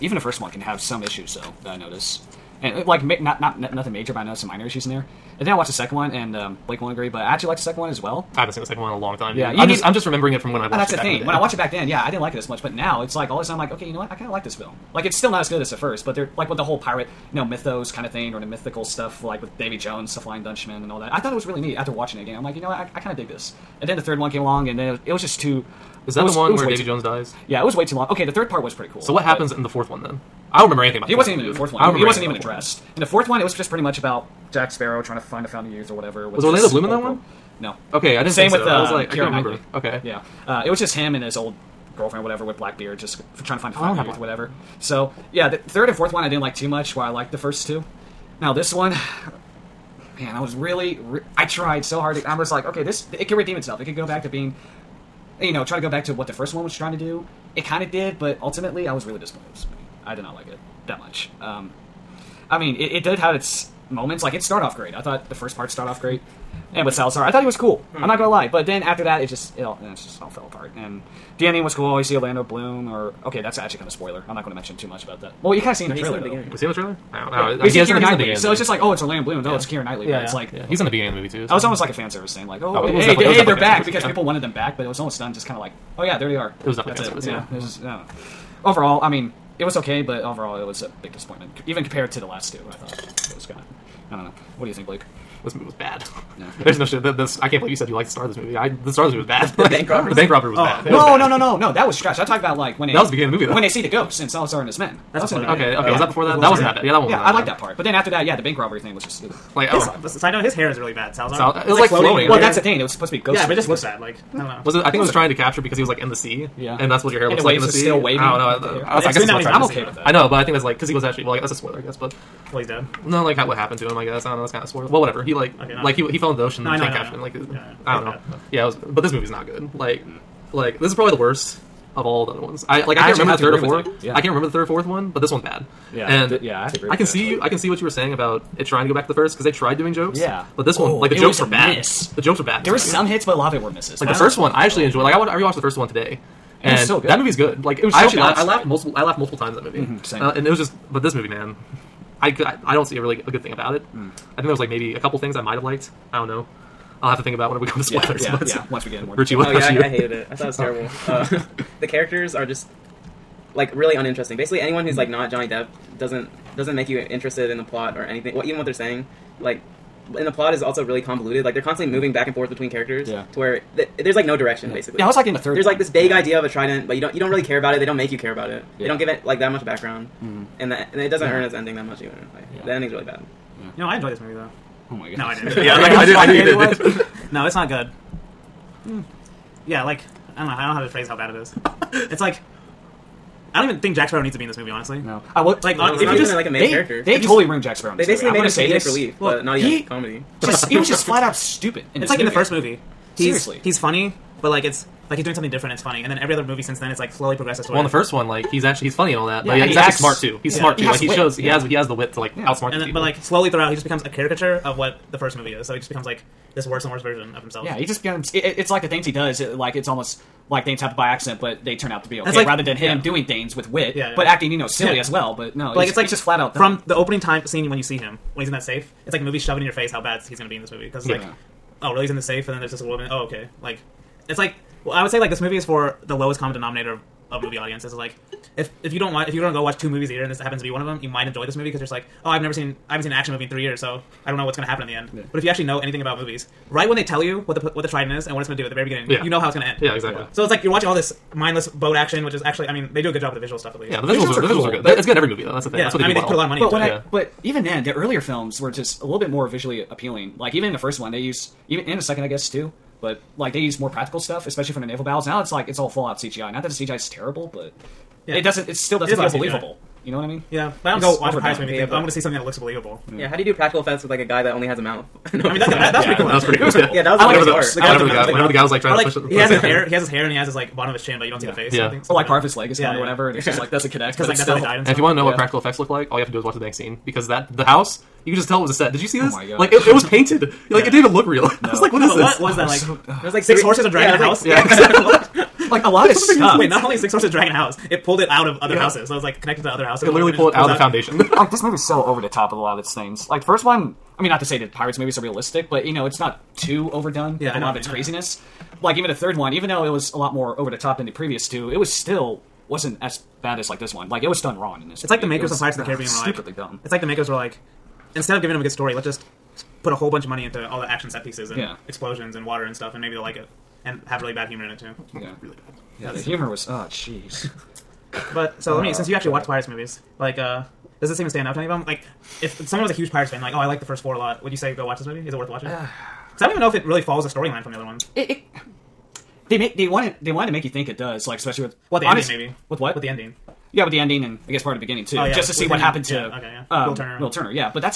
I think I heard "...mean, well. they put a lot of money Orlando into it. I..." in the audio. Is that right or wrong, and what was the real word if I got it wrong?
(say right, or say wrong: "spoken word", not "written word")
wrong: "But", not "Orlando".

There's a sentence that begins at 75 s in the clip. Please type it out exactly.
Well, you kind of seen no, the trailer.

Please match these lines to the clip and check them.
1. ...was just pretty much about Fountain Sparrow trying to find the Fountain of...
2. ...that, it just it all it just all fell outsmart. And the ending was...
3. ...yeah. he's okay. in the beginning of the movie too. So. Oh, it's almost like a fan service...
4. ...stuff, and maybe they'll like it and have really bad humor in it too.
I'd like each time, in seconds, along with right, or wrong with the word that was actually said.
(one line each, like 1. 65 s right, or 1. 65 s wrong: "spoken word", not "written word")
1. 33 s wrong: "Jack", not "Fountain"
2. 69 s wrong: "apart", not "outsmart"
3. 80 s right
4. 322 s right.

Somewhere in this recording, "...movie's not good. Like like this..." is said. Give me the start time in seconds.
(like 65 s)
129 s.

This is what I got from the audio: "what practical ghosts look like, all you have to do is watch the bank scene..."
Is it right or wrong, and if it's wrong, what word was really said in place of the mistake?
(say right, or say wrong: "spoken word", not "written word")
wrong: "effects", not "ghosts".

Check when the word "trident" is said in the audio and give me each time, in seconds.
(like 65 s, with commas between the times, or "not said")
176 s, 247 s.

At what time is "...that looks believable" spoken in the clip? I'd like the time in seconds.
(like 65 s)
272 s.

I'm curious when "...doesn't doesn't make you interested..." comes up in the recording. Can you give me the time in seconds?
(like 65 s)
165 s.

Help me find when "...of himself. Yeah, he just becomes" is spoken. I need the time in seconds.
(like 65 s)
217 s.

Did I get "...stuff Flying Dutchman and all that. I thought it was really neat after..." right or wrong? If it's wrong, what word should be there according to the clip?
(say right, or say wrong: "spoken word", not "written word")
right.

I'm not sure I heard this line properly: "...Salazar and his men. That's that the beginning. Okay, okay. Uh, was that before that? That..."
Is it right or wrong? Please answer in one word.
right.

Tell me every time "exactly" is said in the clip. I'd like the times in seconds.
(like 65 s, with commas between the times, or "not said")
249 s, 294 s.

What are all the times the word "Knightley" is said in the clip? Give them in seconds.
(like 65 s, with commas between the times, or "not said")
39 s, 79 s.